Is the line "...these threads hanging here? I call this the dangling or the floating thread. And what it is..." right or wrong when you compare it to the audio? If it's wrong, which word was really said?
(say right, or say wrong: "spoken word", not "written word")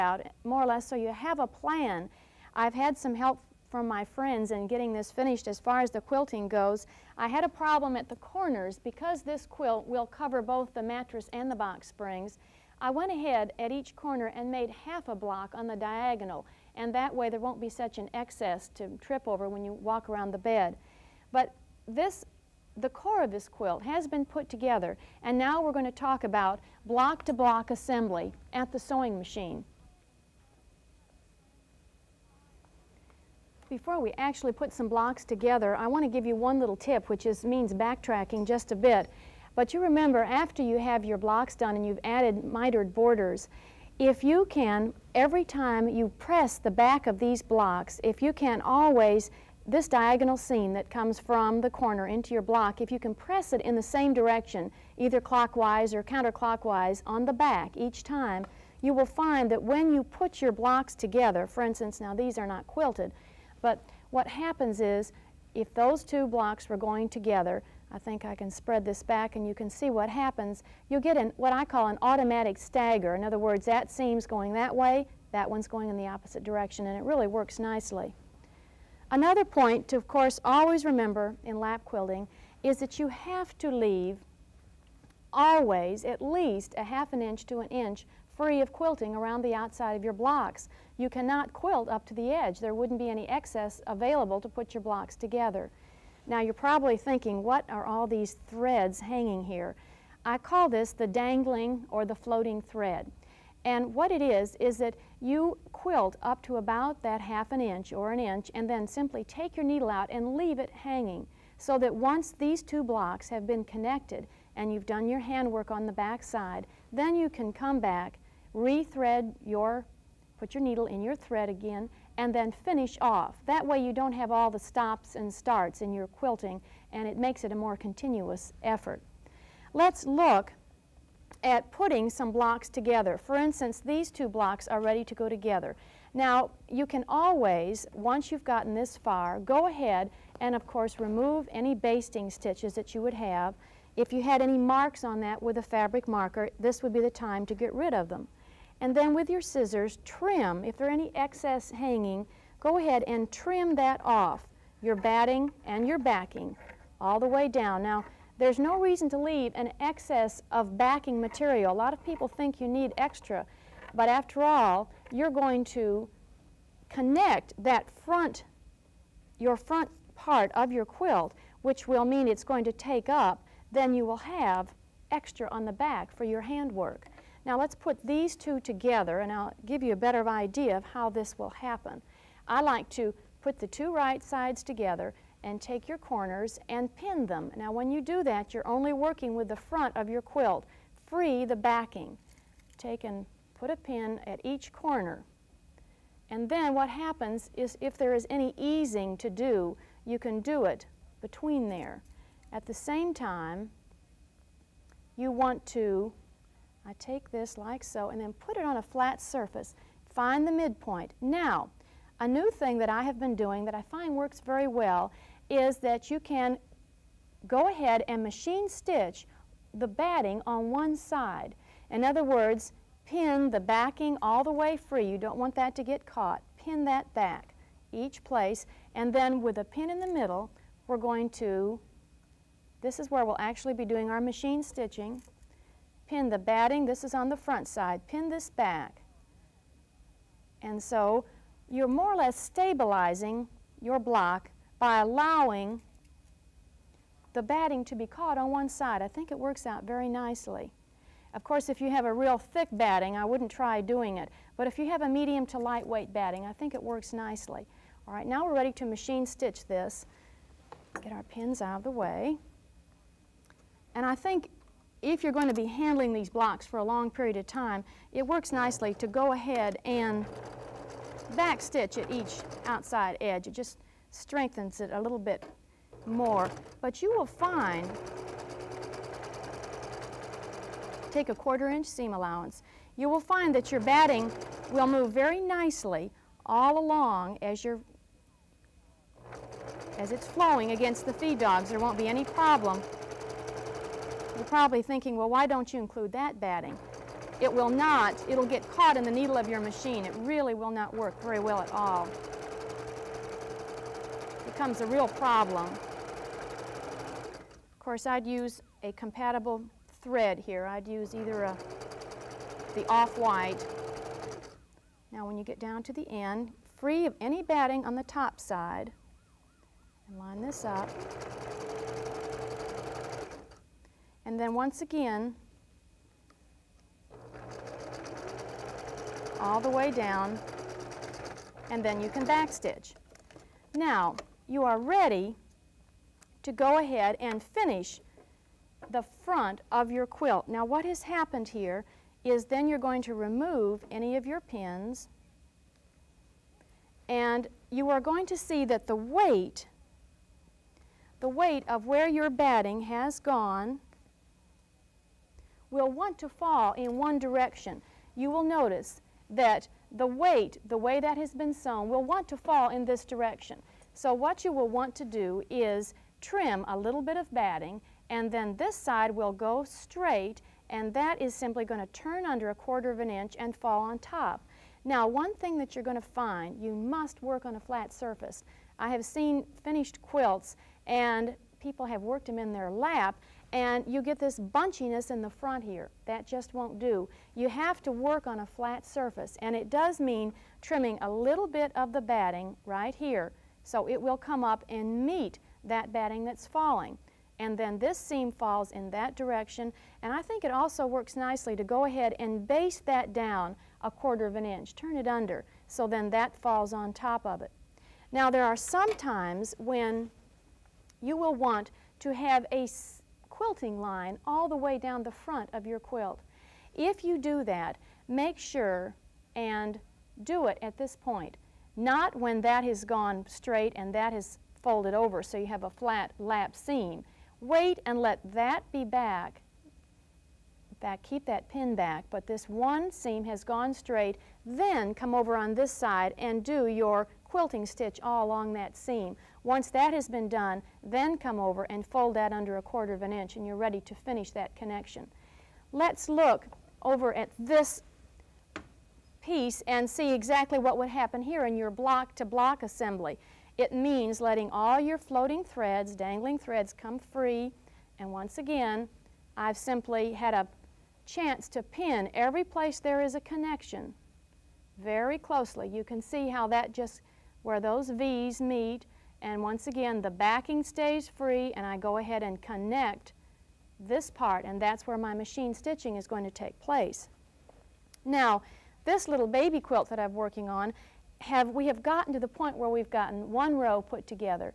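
right.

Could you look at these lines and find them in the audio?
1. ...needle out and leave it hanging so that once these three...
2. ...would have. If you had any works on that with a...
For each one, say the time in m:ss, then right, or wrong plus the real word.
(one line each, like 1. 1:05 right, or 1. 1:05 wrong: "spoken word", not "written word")
1. 1:49 wrong: "two", not "three"
2. 2:23 wrong: "marks", not "works".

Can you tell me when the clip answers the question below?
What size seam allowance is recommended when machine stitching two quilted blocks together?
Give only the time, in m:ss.
4:41.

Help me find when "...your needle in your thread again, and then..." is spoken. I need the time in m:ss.
2:00.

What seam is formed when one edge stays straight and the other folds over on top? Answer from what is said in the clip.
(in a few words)
flat lap seam.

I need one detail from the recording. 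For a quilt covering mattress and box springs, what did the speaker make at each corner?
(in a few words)
half a block on the diagonal.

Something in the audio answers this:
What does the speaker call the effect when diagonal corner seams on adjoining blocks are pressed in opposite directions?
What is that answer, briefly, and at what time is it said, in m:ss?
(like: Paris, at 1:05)
automatic stagger, at 1:12.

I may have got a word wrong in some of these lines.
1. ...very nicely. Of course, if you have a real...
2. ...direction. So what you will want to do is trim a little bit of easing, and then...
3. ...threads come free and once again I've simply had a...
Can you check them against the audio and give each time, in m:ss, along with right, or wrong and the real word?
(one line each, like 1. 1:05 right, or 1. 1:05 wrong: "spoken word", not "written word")
1. 4:09 right
2. 6:03 wrong: "batting", not "easing"
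3. 7:36 right.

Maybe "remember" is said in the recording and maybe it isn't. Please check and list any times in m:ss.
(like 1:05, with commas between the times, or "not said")
0:39, 1:20.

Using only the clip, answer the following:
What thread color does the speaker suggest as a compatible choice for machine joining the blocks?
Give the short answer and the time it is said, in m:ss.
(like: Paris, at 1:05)
off-white, at 5:12.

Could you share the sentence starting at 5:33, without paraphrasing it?
Now, you are ready to go ahead and finish the front of your quilt.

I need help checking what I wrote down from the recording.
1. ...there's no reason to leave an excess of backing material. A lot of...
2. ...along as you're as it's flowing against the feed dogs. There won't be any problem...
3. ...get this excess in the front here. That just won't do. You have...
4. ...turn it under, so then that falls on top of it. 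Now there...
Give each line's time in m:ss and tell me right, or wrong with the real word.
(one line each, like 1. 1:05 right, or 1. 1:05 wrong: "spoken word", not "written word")
1. 2:38 right
2. 4:46 right
3. 6:24 wrong: "bunchiness", not "excess"
4. 6:44 right.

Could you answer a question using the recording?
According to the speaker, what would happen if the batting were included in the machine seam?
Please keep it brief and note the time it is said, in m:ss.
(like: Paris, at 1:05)
caught in the needle, at 4:58.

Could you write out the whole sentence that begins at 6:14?
Now, one thing that you're going to find, you must work on a flat surface.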